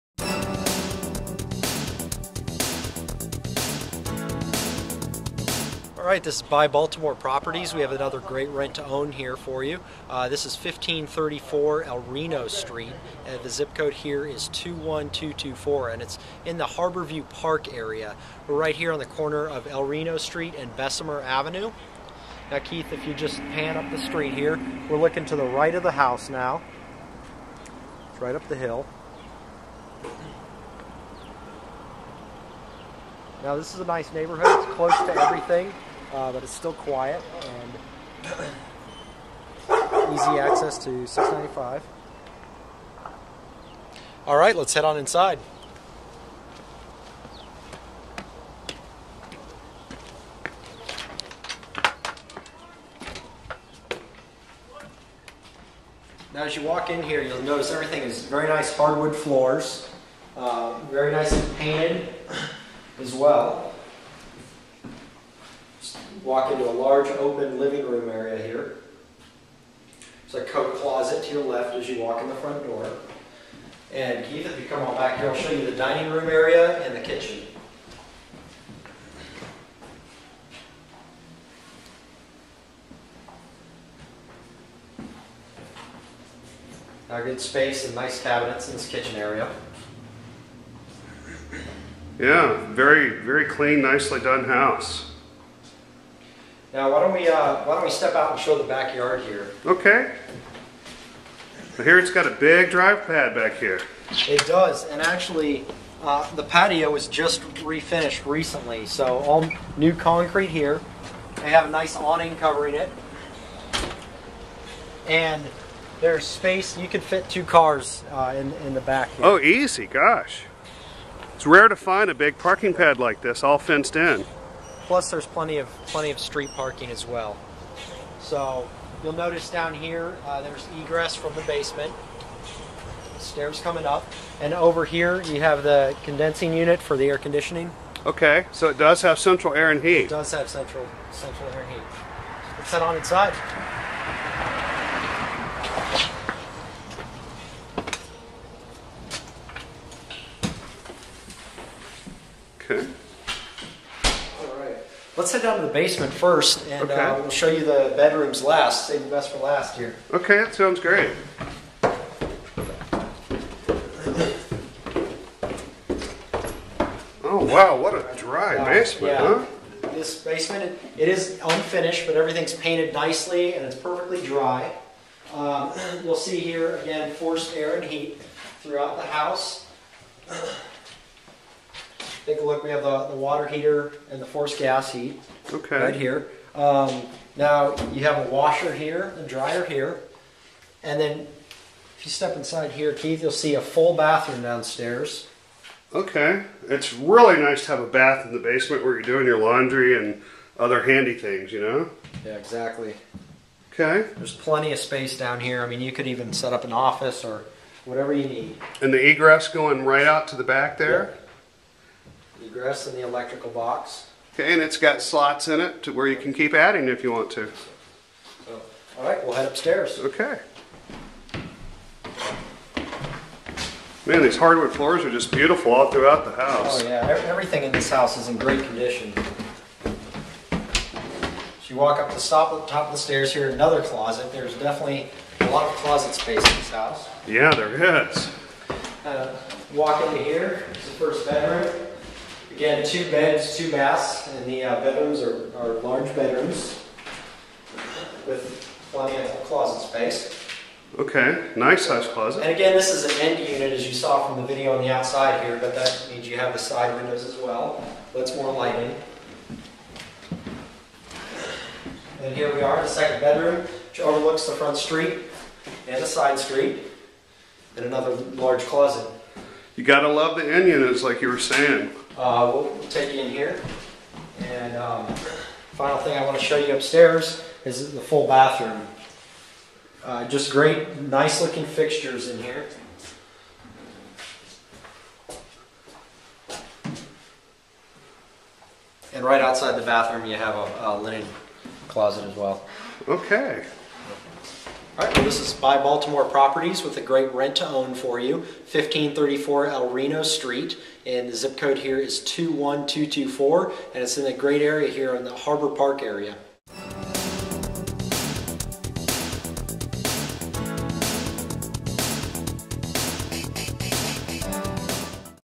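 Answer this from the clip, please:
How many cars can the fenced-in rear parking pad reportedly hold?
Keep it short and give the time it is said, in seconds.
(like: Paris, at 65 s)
2, at 117 s.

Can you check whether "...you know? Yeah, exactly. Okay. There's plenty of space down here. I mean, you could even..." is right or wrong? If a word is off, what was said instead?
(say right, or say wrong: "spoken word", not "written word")
right.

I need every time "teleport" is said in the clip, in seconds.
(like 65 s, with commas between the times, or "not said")
not said.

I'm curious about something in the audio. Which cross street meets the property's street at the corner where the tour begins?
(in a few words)
Bessemer Avenue.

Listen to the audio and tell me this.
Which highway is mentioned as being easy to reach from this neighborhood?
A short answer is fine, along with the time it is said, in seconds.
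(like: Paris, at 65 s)
695, at 41 s.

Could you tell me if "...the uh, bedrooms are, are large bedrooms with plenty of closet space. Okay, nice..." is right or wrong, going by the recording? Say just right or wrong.
right.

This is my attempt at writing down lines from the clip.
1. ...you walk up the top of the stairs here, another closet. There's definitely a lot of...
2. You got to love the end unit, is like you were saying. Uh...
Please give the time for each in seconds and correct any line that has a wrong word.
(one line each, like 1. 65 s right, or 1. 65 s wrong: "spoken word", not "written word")
1. 231 s right
2. 269 s right.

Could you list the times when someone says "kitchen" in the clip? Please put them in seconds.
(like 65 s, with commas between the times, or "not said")
77 s, 88 s.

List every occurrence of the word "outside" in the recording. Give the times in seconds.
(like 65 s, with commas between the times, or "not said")
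254 s, 289 s.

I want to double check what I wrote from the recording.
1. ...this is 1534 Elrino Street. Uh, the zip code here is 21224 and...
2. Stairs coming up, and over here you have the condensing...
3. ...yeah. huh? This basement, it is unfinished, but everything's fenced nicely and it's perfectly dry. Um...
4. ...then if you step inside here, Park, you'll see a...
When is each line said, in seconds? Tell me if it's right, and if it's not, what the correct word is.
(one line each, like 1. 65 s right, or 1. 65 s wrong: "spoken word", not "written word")
1. 10 s right
2. 133 s right
3. 169 s wrong: "painted", not "fenced"
4. 190 s wrong: "Keith", not "Park".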